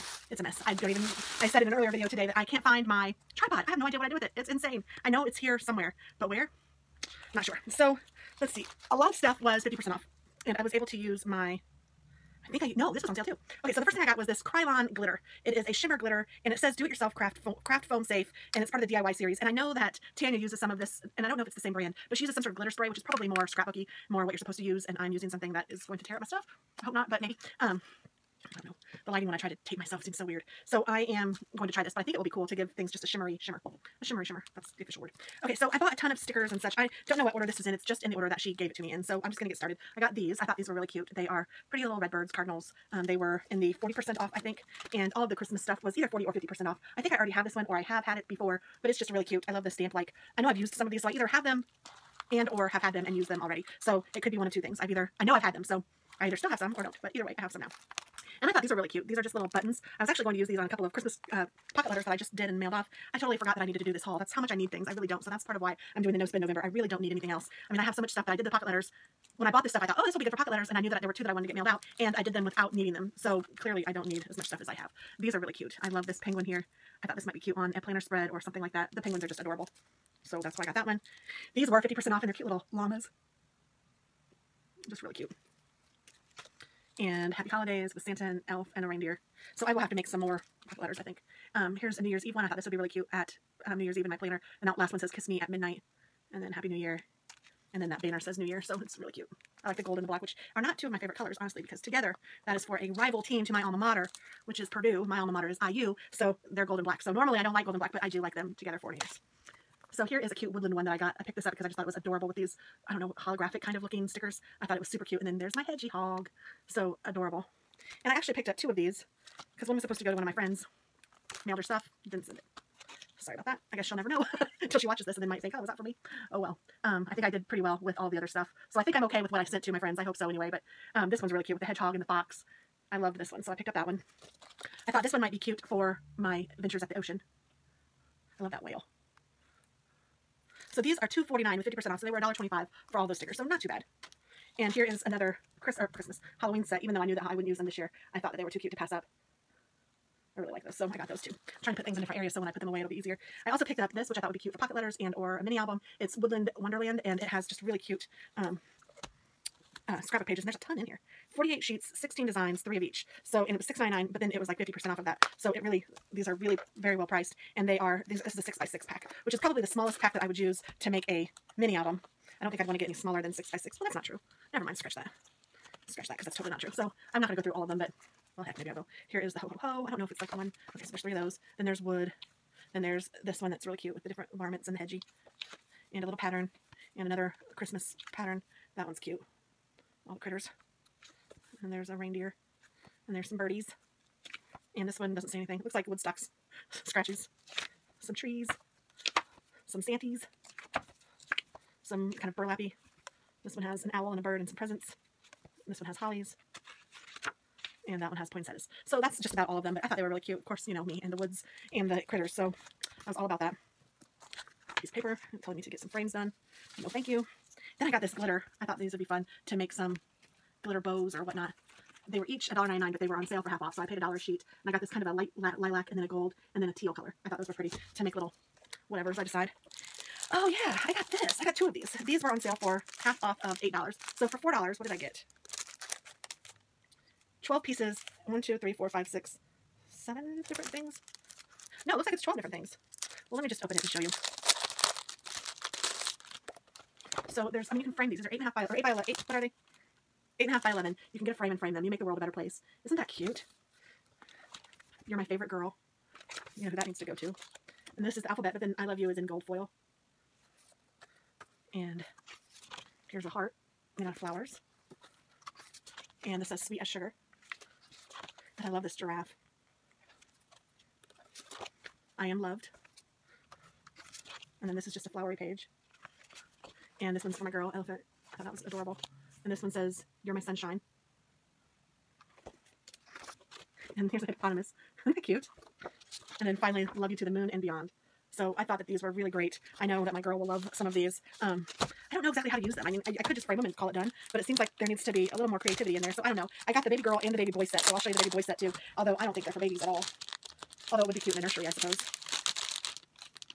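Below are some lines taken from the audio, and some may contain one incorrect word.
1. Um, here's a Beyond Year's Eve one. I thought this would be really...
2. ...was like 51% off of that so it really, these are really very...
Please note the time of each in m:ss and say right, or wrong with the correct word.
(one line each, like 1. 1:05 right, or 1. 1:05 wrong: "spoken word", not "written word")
1. 1:31 wrong: "New", not "Beyond"
2. 2:44 wrong: "50", not "51".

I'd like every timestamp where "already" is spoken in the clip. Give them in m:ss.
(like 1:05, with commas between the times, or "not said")
0:47, 0:53.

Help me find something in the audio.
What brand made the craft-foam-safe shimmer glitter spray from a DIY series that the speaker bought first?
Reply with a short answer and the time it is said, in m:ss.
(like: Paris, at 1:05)
Krylon, at 0:14.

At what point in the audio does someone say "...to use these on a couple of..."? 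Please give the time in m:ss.
1:00.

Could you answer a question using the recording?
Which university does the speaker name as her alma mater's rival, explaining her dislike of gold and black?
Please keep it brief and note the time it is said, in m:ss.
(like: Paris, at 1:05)
Purdue, at 1:44.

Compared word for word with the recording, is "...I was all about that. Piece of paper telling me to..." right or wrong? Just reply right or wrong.
right.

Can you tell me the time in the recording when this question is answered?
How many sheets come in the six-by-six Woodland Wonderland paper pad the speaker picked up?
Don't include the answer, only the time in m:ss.
2:41.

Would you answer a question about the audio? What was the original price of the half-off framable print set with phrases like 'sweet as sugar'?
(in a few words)
$8.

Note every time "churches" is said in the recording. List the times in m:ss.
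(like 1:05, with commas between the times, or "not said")
not said.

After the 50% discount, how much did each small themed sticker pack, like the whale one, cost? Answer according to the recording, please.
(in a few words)
$1.25.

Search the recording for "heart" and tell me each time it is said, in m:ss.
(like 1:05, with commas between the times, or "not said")
4:23.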